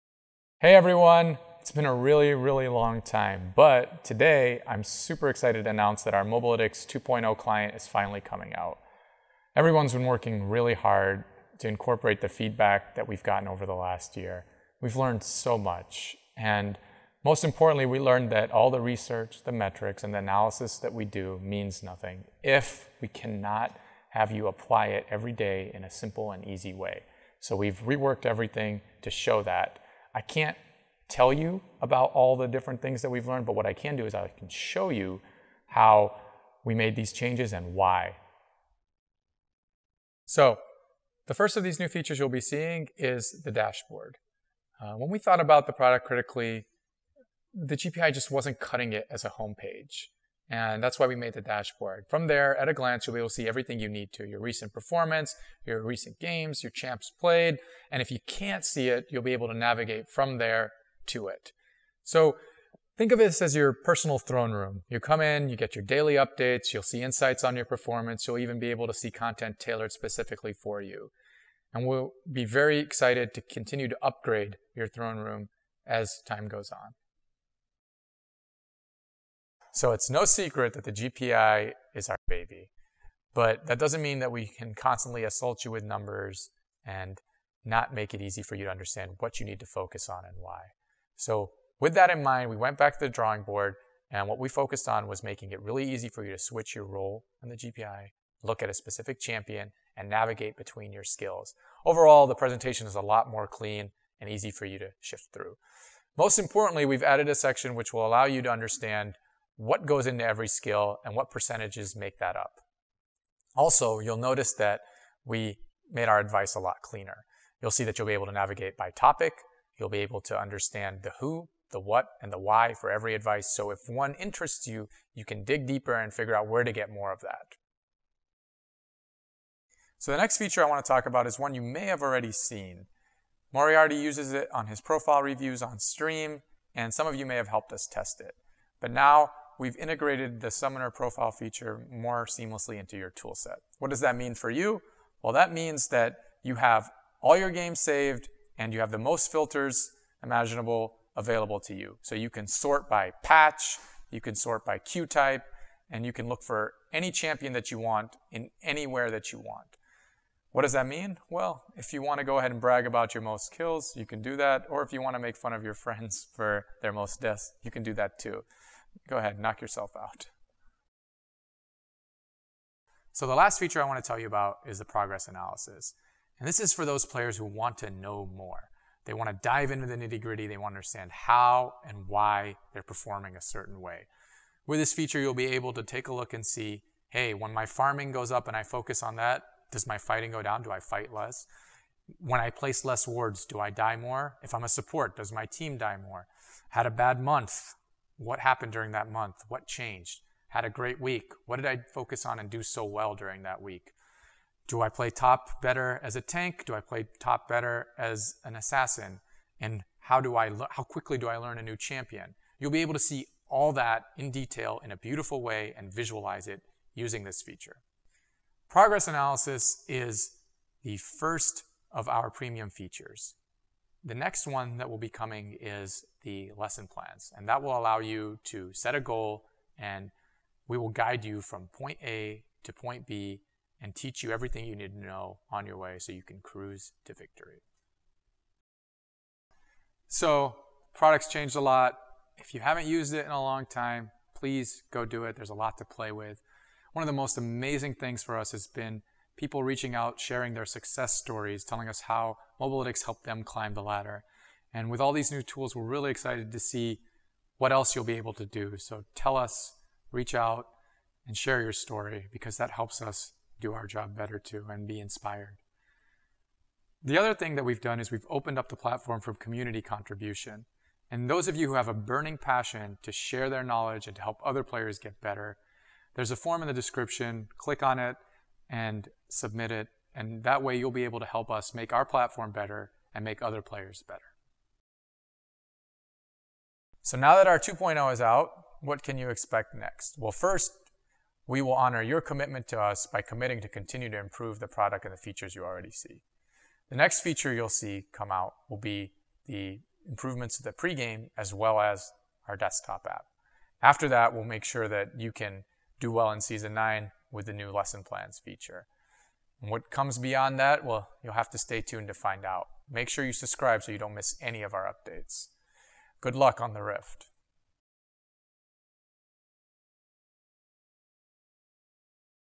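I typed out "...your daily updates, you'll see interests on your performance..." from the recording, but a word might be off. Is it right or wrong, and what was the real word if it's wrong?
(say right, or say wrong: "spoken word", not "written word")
wrong: "insights", not "interests".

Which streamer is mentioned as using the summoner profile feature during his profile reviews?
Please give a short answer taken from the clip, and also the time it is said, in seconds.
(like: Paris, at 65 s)
Moriarty, at 133 s.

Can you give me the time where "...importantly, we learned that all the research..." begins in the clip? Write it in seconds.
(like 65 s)
17 s.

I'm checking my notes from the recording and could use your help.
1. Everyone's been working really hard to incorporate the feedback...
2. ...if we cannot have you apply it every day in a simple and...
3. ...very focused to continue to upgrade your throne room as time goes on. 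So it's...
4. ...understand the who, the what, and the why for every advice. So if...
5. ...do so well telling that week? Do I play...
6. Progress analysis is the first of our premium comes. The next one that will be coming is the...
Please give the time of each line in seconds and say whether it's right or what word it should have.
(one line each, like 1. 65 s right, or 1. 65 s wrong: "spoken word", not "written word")
1. 9 s right
2. 22 s right
3. 72 s wrong: "excited", not "focused"
4. 120 s right
5. 202 s wrong: "during", not "telling"
6. 218 s wrong: "features", not "comes".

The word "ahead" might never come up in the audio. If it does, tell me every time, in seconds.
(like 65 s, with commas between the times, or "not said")
162 s, 169 s.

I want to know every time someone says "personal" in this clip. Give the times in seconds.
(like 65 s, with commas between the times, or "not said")
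63 s.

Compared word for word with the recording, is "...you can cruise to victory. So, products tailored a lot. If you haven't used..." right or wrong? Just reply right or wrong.
wrong.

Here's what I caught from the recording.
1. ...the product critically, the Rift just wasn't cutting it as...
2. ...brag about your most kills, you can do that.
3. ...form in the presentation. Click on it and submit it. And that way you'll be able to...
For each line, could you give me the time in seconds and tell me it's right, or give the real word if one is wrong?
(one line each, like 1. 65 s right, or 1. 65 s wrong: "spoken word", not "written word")
1. 45 s wrong: "GPI", not "Rift"
2. 162 s right
3. 276 s wrong: "description", not "presentation".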